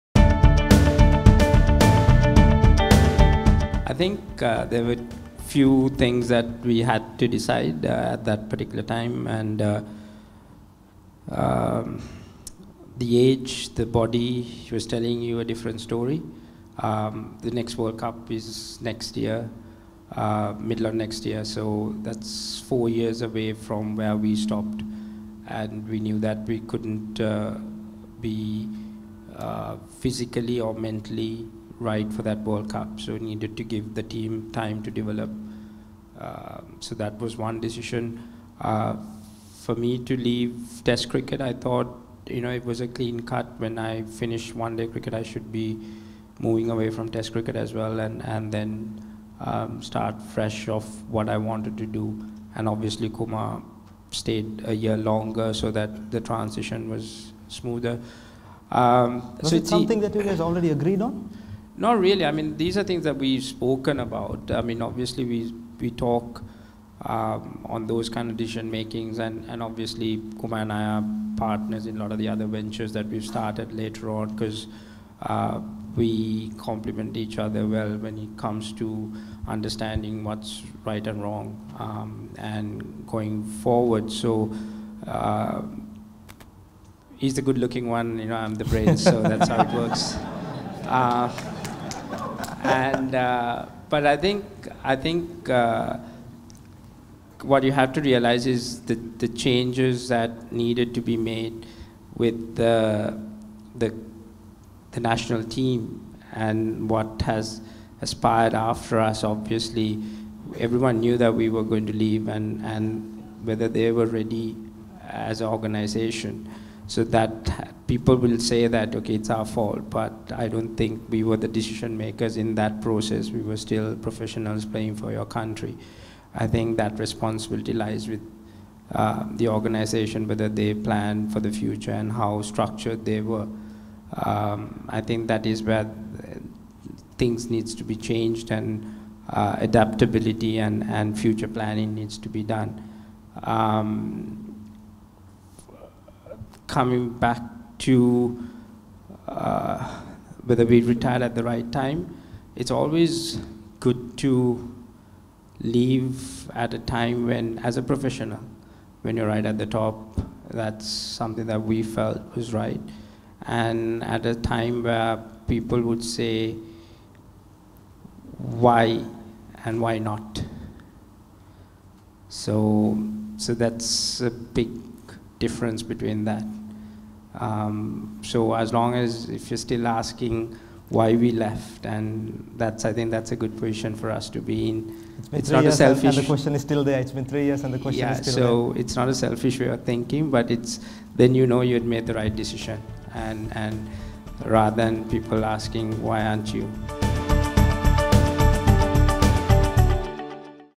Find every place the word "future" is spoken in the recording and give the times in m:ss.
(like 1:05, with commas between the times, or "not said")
2:11, 2:21.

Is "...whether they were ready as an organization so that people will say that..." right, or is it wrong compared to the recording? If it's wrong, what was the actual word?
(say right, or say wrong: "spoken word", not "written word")
right.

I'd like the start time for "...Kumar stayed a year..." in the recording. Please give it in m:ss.
0:53.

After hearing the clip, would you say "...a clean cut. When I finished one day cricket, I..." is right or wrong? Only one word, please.
right.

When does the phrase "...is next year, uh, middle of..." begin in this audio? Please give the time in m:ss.
0:18.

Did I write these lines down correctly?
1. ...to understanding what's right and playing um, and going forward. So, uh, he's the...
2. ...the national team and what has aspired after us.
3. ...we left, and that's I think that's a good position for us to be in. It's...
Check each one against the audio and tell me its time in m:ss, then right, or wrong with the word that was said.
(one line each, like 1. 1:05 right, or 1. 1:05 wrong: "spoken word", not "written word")
1. 1:18 wrong: "wrong", not "playing"
2. 1:44 right
3. 3:01 right.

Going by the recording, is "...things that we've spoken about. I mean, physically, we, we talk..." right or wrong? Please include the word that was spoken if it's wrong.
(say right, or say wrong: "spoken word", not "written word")
wrong: "obviously", not "physically".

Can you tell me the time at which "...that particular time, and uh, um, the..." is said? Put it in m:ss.
0:08.